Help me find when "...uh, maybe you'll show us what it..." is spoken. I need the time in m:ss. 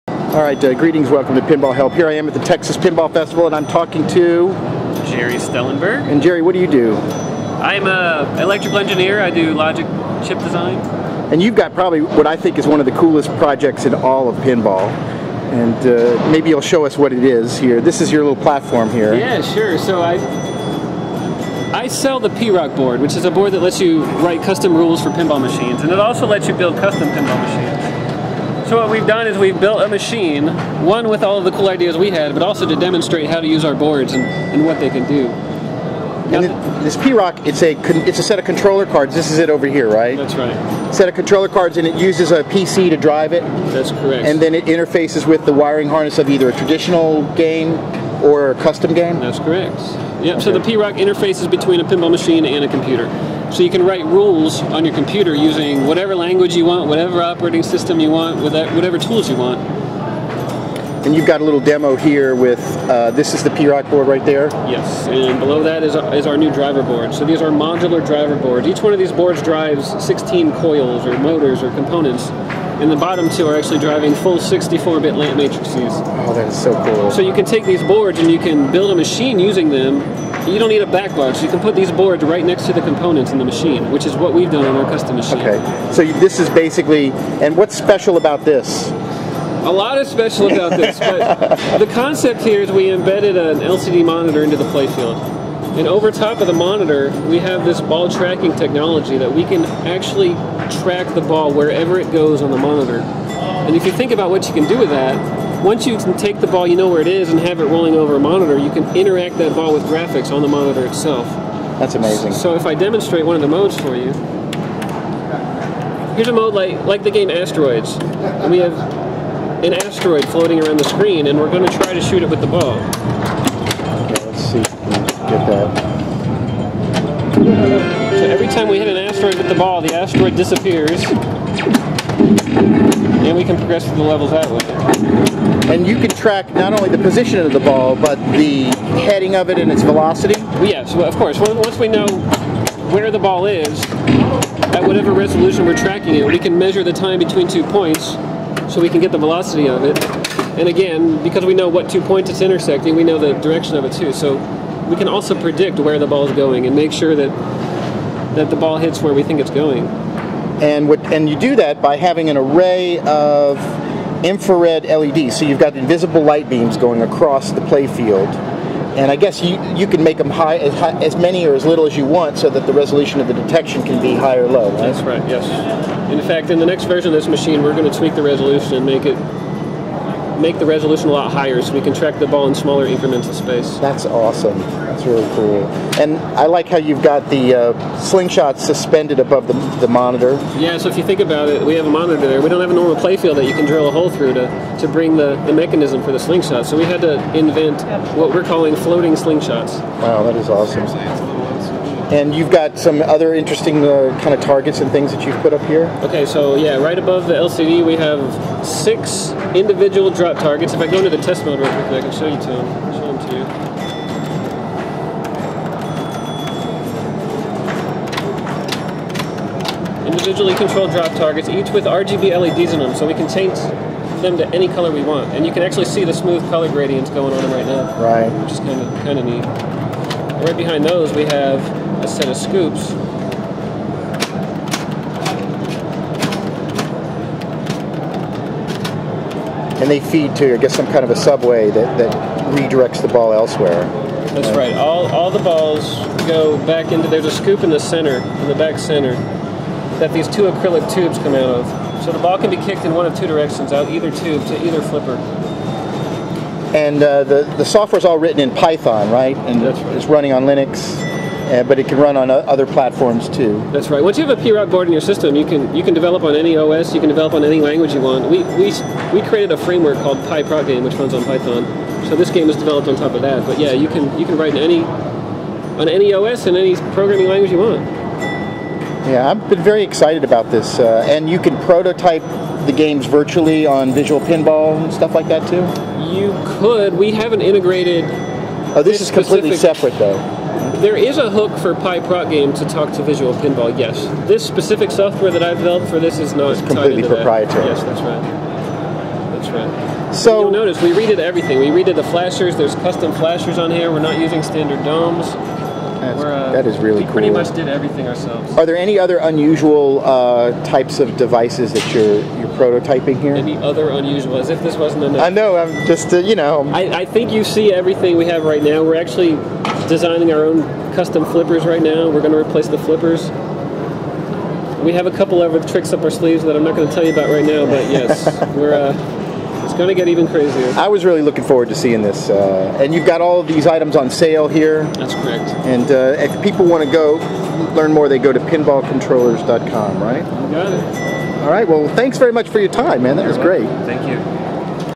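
0:15.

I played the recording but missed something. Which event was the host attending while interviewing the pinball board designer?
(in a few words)
Texas Pinball Festival.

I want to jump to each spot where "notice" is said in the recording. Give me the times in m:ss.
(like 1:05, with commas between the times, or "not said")
5:00.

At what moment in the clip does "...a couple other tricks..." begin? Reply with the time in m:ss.
5:25.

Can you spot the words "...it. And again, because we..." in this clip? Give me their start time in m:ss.
2:29.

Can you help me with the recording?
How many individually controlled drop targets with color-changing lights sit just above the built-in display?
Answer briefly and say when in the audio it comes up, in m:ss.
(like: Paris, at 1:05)
6, at 3:28.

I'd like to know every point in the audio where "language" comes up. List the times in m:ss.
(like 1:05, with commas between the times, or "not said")
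0:56, 4:27, 4:37.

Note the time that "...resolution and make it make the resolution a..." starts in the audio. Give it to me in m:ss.
2:58.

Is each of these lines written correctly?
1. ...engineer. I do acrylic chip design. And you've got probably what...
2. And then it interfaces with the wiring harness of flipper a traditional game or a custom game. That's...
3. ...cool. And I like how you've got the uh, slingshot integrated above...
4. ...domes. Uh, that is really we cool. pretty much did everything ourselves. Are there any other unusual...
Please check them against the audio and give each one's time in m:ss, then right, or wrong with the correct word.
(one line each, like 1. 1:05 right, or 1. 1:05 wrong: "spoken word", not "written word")
1. 0:08 wrong: "logic", not "acrylic"
2. 0:44 wrong: "either", not "flipper"
3. 3:05 wrong: "suspended", not "integrated"
4. 5:04 right.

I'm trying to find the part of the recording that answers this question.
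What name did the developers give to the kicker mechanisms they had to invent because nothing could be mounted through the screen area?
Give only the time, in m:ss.
3:18.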